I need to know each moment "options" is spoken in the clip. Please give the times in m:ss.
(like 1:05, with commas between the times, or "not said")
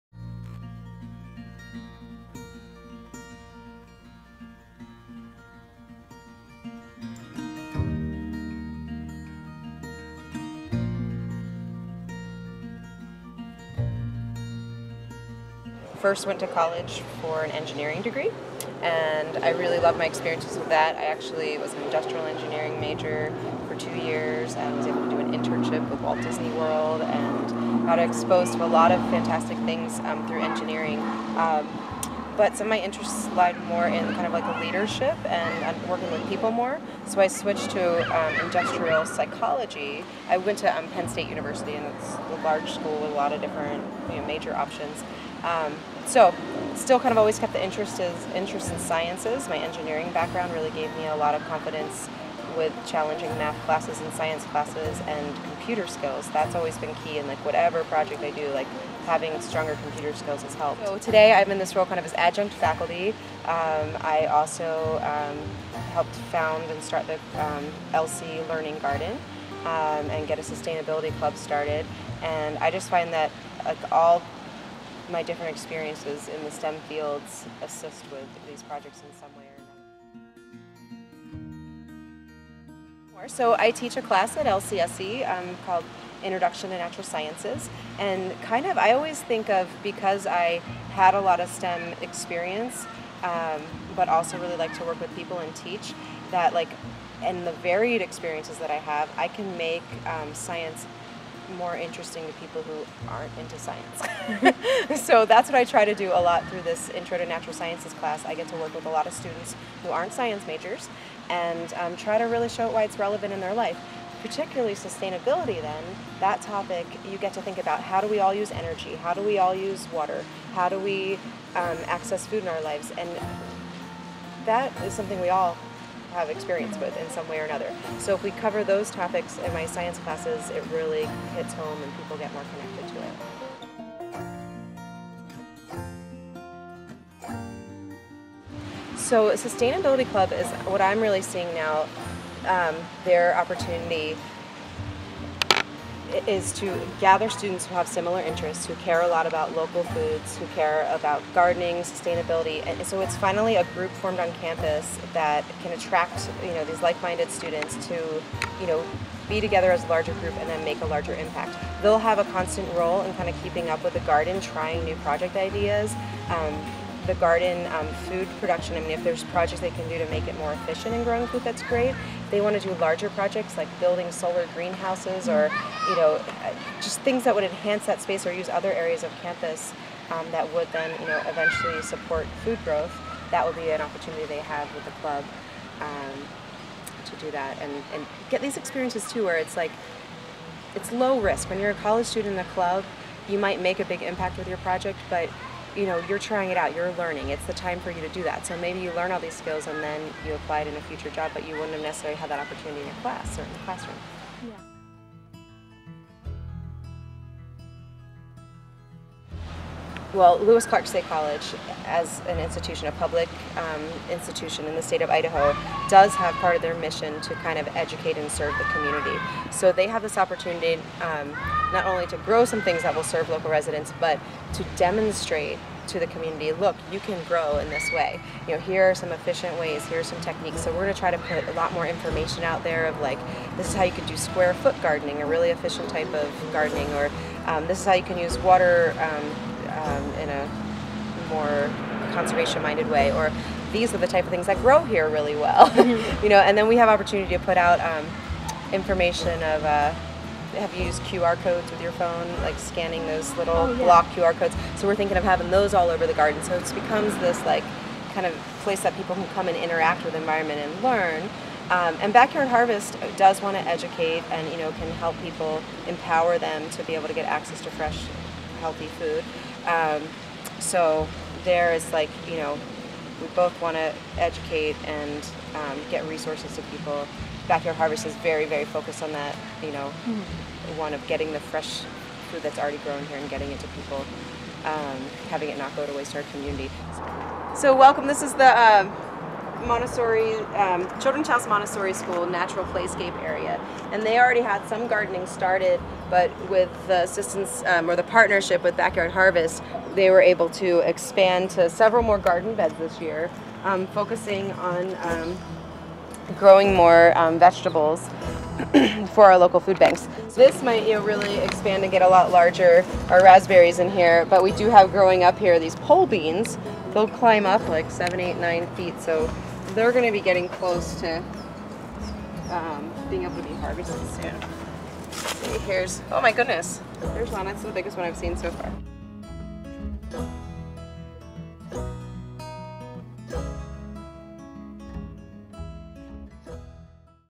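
0:44.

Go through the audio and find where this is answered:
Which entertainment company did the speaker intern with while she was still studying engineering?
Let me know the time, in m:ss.
0:26.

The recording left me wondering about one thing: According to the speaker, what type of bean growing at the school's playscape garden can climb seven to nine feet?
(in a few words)
Pole beans.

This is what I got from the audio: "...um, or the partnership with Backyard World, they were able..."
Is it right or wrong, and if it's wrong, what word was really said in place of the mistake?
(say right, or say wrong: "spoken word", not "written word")
wrong: "Harvest", not "World".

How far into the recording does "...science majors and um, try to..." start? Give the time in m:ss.
1:50.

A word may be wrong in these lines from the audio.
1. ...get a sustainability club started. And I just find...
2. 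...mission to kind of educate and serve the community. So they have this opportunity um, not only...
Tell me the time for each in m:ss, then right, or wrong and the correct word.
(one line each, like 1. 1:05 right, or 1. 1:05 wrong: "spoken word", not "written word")
1. 1:10 right
2. 3:36 right.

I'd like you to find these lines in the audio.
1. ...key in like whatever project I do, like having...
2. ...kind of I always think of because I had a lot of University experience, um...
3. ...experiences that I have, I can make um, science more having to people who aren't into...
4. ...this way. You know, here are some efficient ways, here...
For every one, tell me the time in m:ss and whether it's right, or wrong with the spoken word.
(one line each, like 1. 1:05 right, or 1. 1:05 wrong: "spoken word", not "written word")
1. 0:57 right
2. 1:28 wrong: "STEM", not "University"
3. 1:38 wrong: "interesting", not "having"
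4. 3:47 right.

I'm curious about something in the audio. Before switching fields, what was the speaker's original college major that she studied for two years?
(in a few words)
Industrial engineering.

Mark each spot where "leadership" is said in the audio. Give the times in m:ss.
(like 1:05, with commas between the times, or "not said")
0:34.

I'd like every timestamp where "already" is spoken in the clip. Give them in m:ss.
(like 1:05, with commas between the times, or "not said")
4:42, 4:54.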